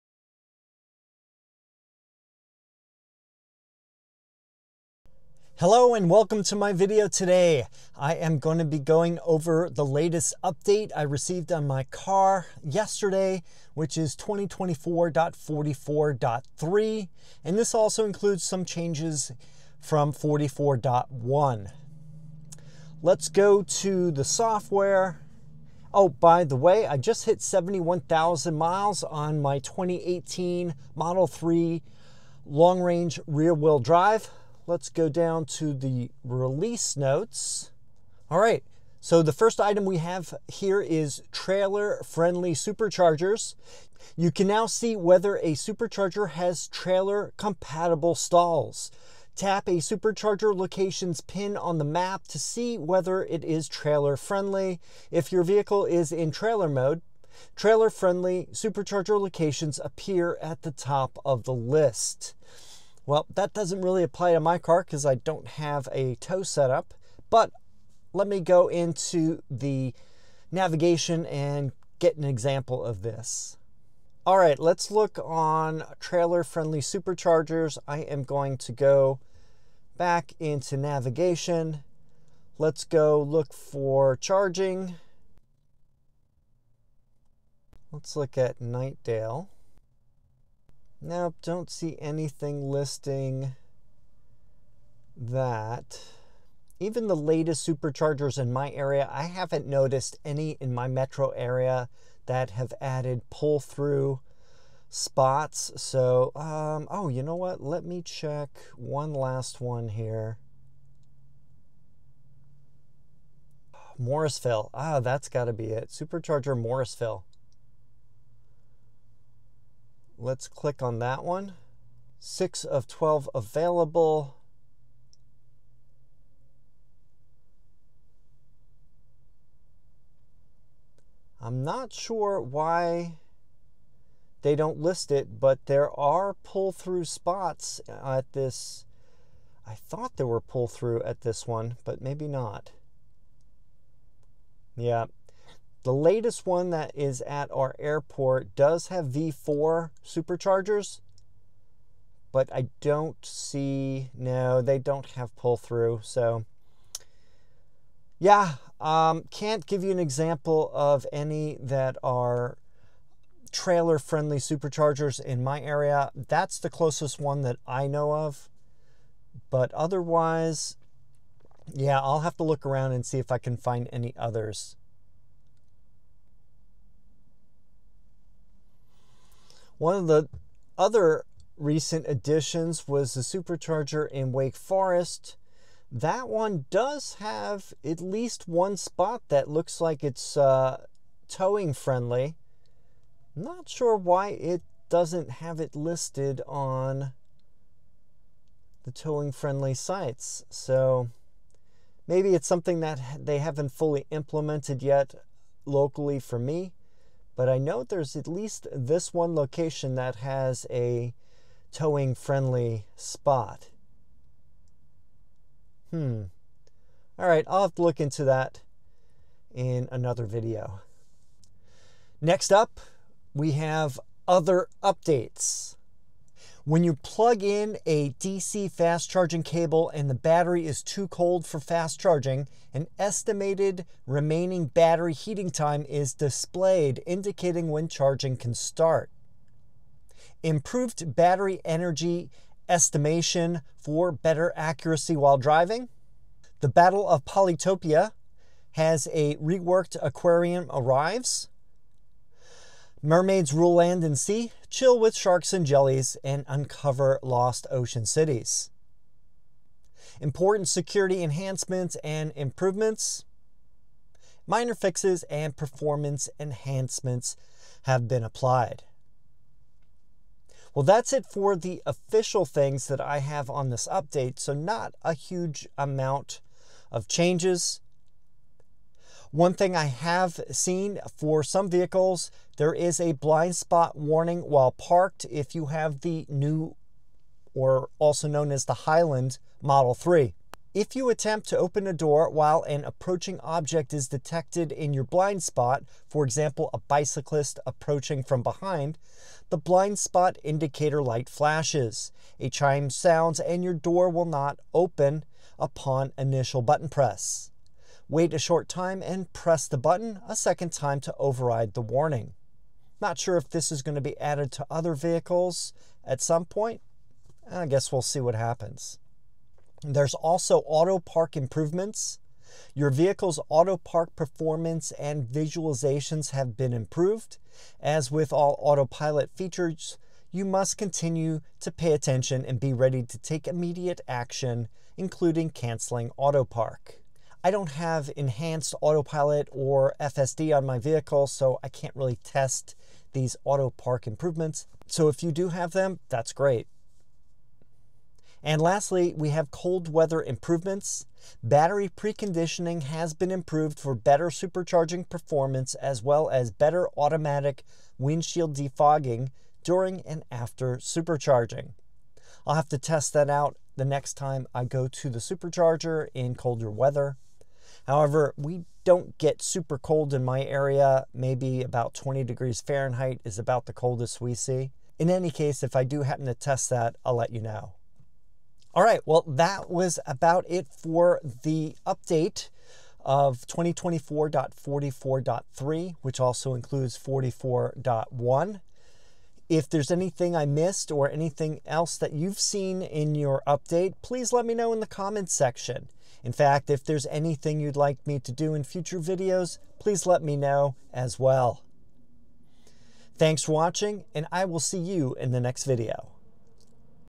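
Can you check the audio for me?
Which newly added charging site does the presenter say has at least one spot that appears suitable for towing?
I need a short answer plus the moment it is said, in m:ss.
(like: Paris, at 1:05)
Wake Forest, at 3:04.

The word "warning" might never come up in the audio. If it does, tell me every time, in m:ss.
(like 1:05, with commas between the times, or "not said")
4:43, 5:11.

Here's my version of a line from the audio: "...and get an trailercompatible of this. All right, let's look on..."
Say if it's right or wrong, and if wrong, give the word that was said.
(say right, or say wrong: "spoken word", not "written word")
wrong: "example", not "trailercompatible".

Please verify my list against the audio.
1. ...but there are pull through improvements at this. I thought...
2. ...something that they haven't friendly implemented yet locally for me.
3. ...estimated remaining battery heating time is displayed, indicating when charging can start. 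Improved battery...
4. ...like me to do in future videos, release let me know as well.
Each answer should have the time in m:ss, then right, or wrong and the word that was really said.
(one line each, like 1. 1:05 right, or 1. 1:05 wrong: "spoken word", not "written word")
1. 2:15 wrong: "spots", not "improvements"
2. 3:22 wrong: "fully", not "friendly"
3. 3:52 right
4. 6:37 wrong: "please", not "release".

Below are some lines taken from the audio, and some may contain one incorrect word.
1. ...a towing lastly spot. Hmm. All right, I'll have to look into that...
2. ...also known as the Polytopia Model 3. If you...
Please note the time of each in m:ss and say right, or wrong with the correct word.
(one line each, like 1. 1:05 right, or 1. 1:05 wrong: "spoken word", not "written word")
1. 3:30 wrong: "friendly", not "lastly"
2. 4:47 wrong: "Highland", not "Polytopia".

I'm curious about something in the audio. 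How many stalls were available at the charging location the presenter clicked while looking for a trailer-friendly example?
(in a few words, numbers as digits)
6 of 12.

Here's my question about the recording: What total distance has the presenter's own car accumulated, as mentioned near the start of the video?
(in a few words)
71,000 miles.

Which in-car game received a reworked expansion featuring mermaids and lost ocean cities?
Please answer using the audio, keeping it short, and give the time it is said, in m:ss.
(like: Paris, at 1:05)
The Battle of Polytopia, at 4:06.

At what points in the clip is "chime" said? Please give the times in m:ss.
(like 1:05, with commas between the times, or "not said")
5:02.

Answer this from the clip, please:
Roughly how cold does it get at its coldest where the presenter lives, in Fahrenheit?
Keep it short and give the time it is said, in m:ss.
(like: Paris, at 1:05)
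20 degrees, at 6:11.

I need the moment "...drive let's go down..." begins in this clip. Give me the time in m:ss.
0:33.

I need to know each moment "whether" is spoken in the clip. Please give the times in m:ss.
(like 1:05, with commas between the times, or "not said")
0:44, 0:52.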